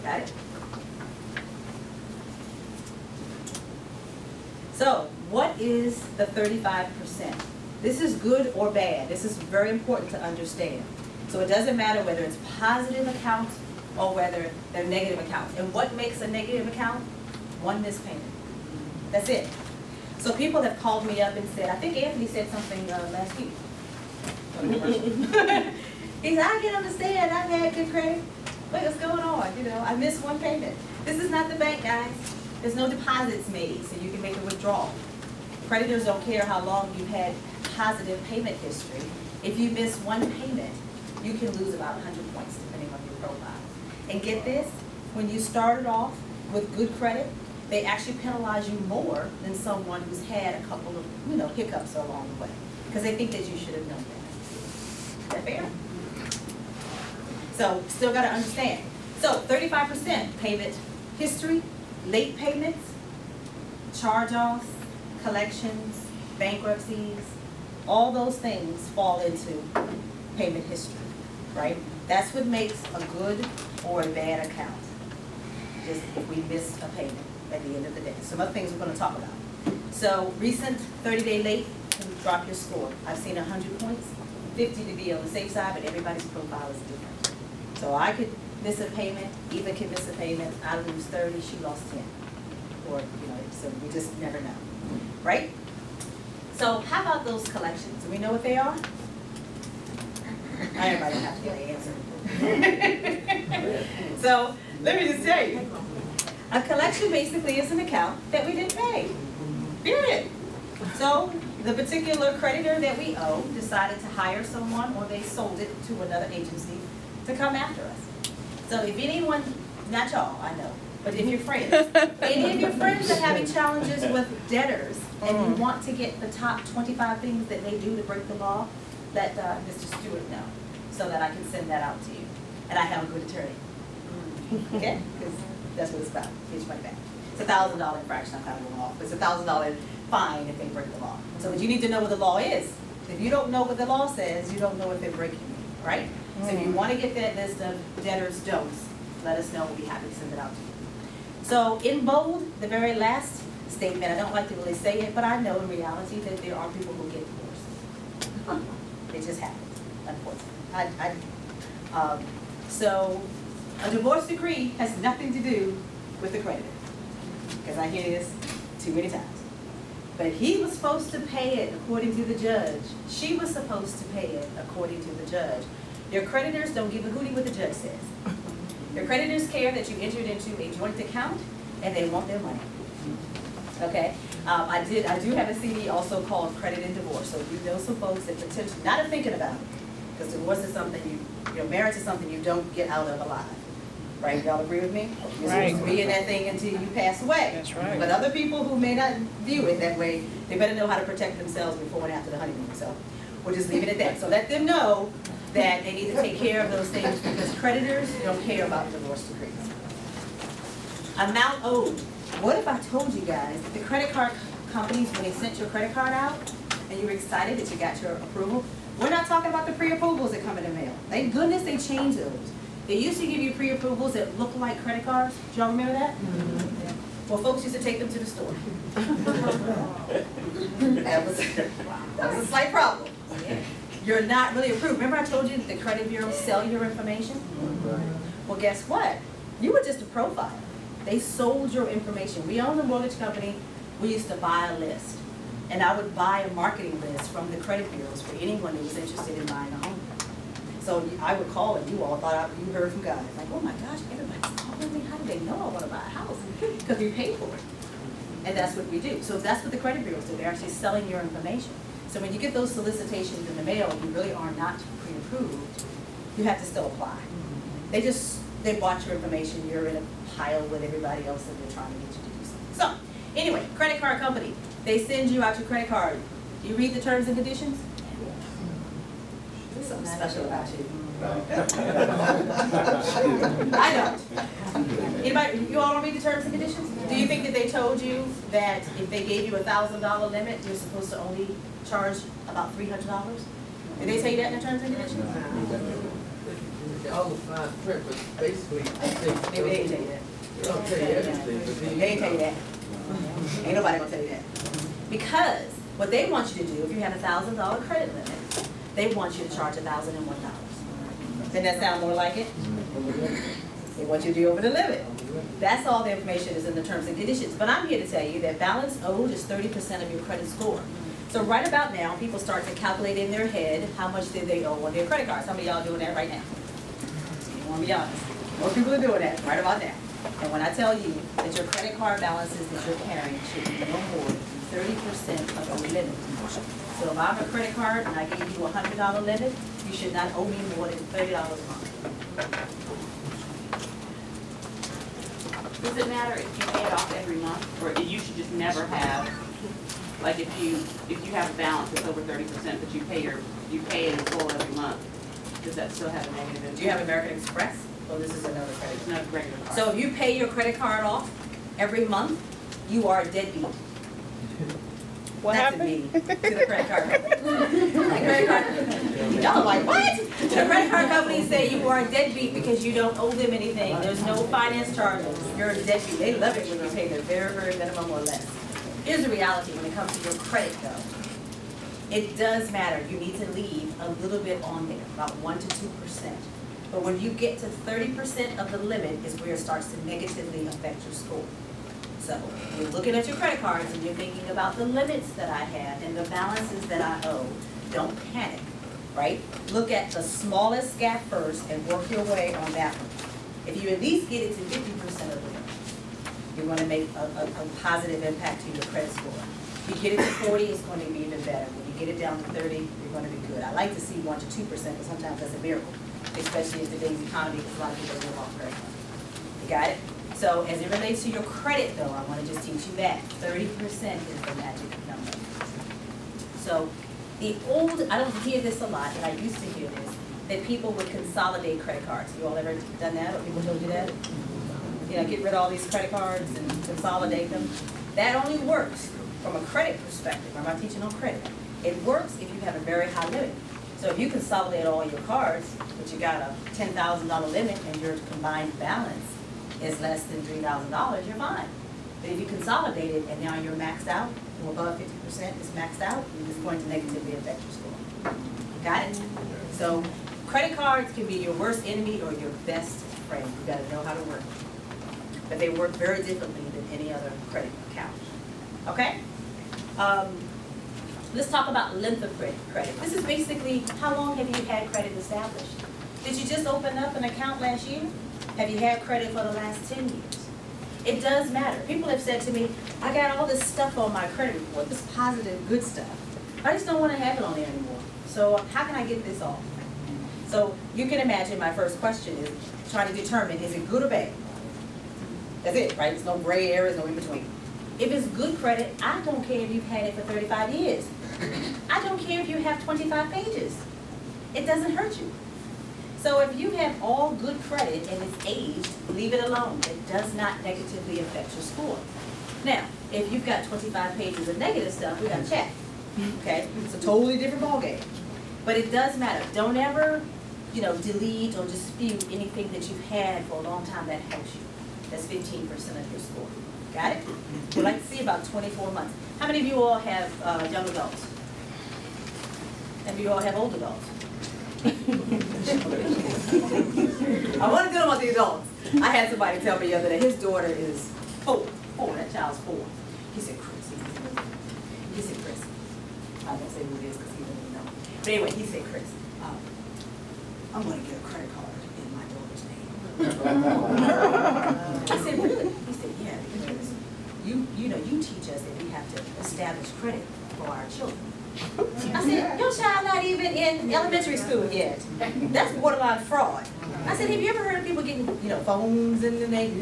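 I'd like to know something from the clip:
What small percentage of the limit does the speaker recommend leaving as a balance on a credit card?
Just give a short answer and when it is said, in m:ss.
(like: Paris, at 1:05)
1 to 2%, at 6:25.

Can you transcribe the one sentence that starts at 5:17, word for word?
But I'm here to tell you that balance owed is 30% of your credit score.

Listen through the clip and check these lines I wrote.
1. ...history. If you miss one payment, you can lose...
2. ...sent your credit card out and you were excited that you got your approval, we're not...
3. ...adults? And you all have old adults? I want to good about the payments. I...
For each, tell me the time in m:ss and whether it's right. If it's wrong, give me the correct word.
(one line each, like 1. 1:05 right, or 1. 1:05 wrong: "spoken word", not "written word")
1. 0:38 right
2. 3:35 right
3. 8:50 wrong: "adults", not "payments".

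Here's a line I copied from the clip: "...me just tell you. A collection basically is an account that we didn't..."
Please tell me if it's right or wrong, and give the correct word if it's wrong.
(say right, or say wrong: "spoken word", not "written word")
right.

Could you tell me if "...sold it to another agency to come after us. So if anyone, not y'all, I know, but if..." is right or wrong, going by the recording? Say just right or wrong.
right.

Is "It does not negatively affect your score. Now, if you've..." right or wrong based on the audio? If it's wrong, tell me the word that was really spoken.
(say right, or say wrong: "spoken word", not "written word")
right.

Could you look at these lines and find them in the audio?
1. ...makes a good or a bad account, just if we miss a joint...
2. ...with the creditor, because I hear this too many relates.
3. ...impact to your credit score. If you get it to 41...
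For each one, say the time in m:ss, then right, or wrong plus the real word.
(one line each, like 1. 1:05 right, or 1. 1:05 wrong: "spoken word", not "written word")
1. 1:12 wrong: "payment", not "joint"
2. 2:46 wrong: "times", not "relates"
3. 6:48 wrong: "40", not "41".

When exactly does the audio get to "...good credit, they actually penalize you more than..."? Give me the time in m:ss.
0:46.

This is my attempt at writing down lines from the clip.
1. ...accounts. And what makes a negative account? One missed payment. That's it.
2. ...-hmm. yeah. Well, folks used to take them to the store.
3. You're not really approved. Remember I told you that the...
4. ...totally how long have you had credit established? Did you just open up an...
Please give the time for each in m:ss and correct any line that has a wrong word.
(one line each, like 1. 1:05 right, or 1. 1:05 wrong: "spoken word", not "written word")
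1. 0:15 right
2. 3:46 right
3. 3:54 right
4. 7:53 wrong: "basically", not "totally".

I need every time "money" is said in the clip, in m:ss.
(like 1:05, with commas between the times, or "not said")
2:16, 3:02.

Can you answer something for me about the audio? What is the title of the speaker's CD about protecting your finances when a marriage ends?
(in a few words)
Credit and Divorce.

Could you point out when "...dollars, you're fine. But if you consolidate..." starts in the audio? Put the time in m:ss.
7:30.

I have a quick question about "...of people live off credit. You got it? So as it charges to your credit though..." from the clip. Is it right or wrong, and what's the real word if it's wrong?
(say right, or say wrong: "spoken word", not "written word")
wrong: "relates", not "charges".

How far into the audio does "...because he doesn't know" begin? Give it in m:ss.
9:07.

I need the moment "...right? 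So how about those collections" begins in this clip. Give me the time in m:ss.
1:35.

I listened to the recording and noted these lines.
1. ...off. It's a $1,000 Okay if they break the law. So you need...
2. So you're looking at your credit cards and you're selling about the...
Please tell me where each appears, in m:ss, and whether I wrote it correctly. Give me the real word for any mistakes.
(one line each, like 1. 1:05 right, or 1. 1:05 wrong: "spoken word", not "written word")
1. 2:18 wrong: "Fine", not "Okay"
2. 6:32 wrong: "thinking", not "selling".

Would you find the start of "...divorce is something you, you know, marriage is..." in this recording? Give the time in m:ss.
3:10.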